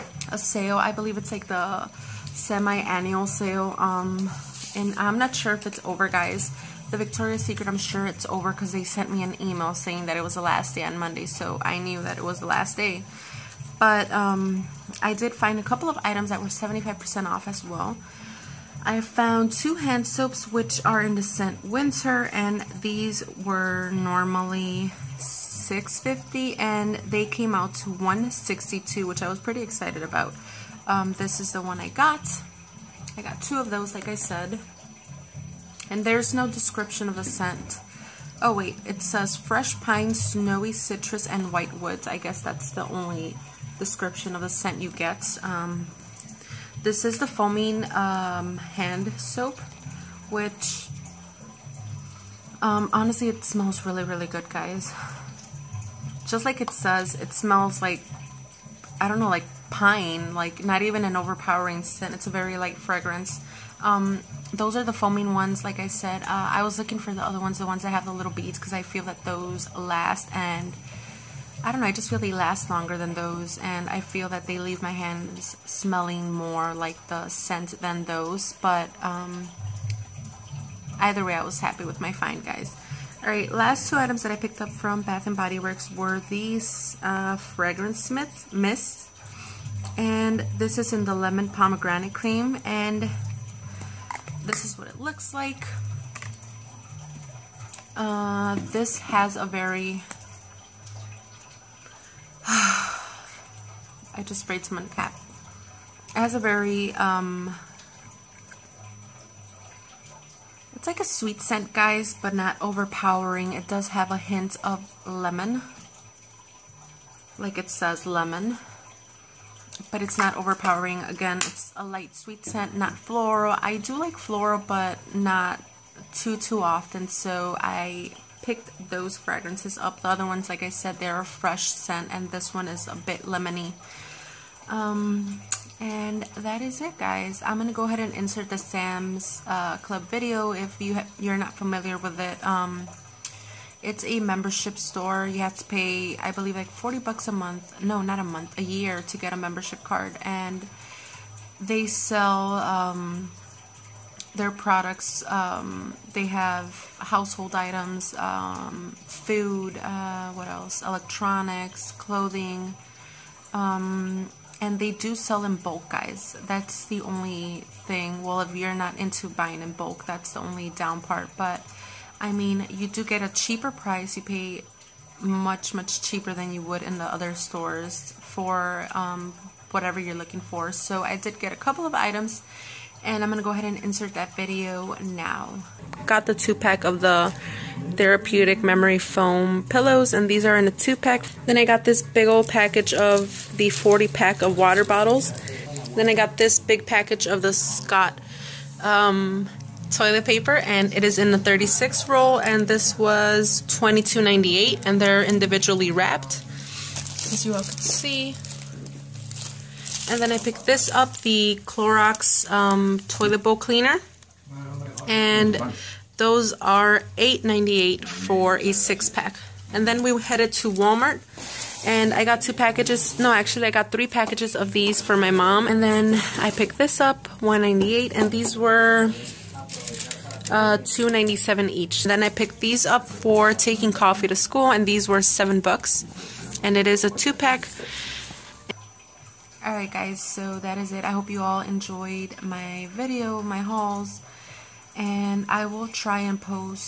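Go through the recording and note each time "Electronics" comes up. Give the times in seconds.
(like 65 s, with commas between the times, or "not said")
160 s.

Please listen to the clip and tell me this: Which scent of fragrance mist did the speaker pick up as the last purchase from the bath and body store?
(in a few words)
Lemon Pomegranate Cream.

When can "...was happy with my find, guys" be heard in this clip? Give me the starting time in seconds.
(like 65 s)
81 s.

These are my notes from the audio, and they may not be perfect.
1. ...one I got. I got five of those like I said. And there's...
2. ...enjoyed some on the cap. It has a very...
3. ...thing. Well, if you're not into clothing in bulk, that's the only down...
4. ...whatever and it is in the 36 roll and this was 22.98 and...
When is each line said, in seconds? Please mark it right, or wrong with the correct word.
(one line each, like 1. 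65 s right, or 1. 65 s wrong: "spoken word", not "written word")
1. 31 s wrong: "two", not "five"
2. 104 s wrong: "sprayed", not "enjoyed"
3. 167 s wrong: "buying", not "clothing"
4. 200 s wrong: "paper", not "whatever".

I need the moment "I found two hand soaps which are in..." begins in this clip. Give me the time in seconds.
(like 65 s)
18 s.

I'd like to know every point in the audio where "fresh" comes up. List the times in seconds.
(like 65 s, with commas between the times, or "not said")
39 s, 131 s.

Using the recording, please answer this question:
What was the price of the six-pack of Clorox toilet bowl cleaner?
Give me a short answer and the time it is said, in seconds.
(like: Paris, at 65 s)
$8.98, at 217 s.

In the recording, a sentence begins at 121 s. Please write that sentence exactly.
Again, it's a light sweet scent, not floral.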